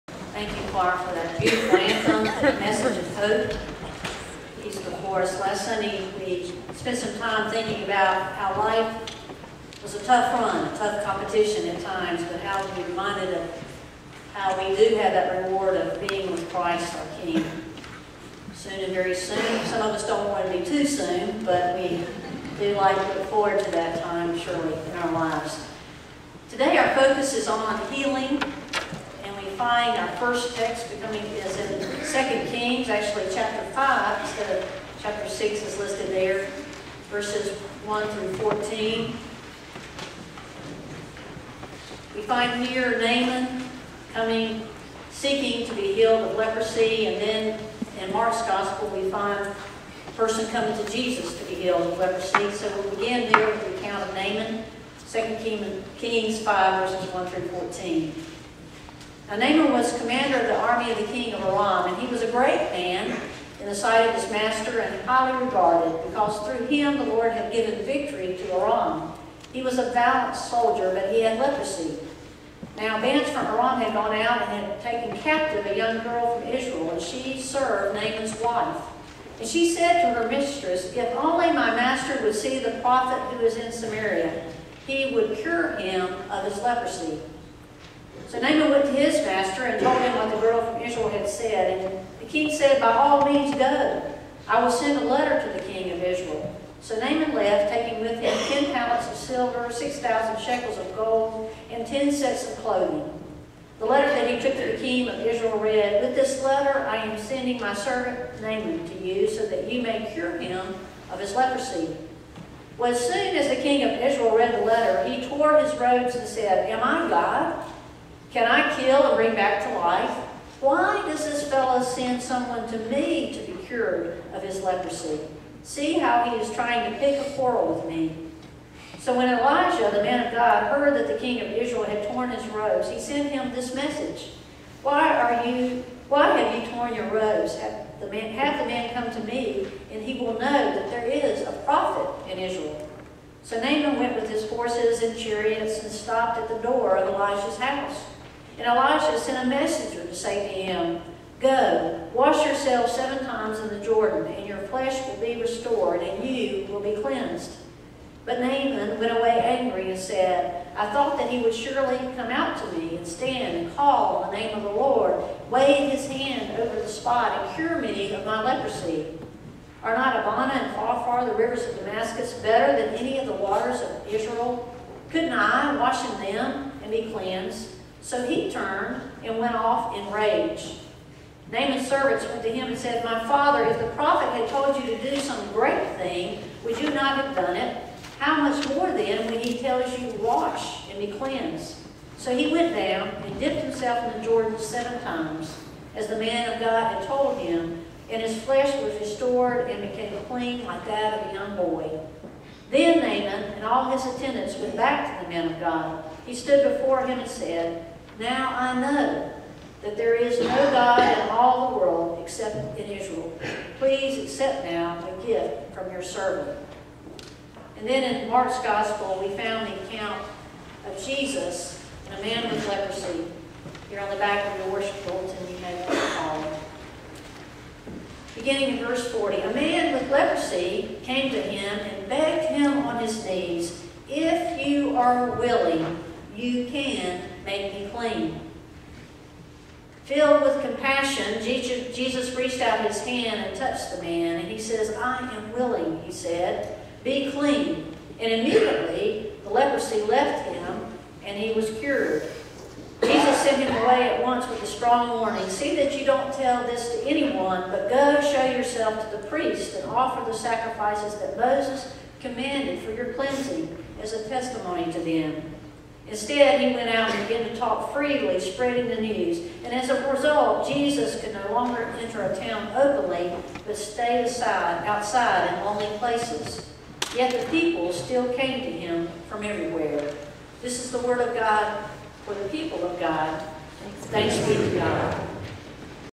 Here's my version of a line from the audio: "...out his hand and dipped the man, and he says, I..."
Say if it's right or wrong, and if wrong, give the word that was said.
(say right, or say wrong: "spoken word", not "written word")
wrong: "touched", not "dipped".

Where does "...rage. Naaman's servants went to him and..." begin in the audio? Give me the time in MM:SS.
03:00.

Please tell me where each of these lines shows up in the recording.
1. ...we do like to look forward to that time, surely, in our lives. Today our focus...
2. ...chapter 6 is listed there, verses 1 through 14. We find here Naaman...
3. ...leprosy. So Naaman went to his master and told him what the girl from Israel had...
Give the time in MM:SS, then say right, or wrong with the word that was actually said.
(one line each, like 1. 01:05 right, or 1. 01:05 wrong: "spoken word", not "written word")
1. 00:21 right
2. 00:35 right
3. 01:26 right.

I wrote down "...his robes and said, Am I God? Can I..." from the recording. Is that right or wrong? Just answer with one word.
right.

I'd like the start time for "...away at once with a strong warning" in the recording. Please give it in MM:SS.
04:13.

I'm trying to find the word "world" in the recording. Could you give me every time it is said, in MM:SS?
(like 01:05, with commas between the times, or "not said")
03:31.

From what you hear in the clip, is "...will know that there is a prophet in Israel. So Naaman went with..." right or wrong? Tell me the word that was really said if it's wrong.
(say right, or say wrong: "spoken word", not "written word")
right.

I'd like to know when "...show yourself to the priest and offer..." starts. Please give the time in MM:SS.
04:18.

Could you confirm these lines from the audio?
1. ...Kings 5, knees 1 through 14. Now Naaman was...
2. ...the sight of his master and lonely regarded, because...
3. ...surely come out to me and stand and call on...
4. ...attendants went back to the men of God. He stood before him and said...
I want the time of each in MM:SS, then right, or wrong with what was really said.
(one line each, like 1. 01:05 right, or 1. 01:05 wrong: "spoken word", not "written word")
1. 00:55 wrong: "verses", not "knees"
2. 01:03 wrong: "highly", not "lonely"
3. 02:41 right
4. 03:24 right.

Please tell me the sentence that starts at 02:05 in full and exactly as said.
See how he is trying to pick a quarrel with me.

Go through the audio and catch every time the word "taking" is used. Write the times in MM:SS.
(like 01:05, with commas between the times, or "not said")
01:37.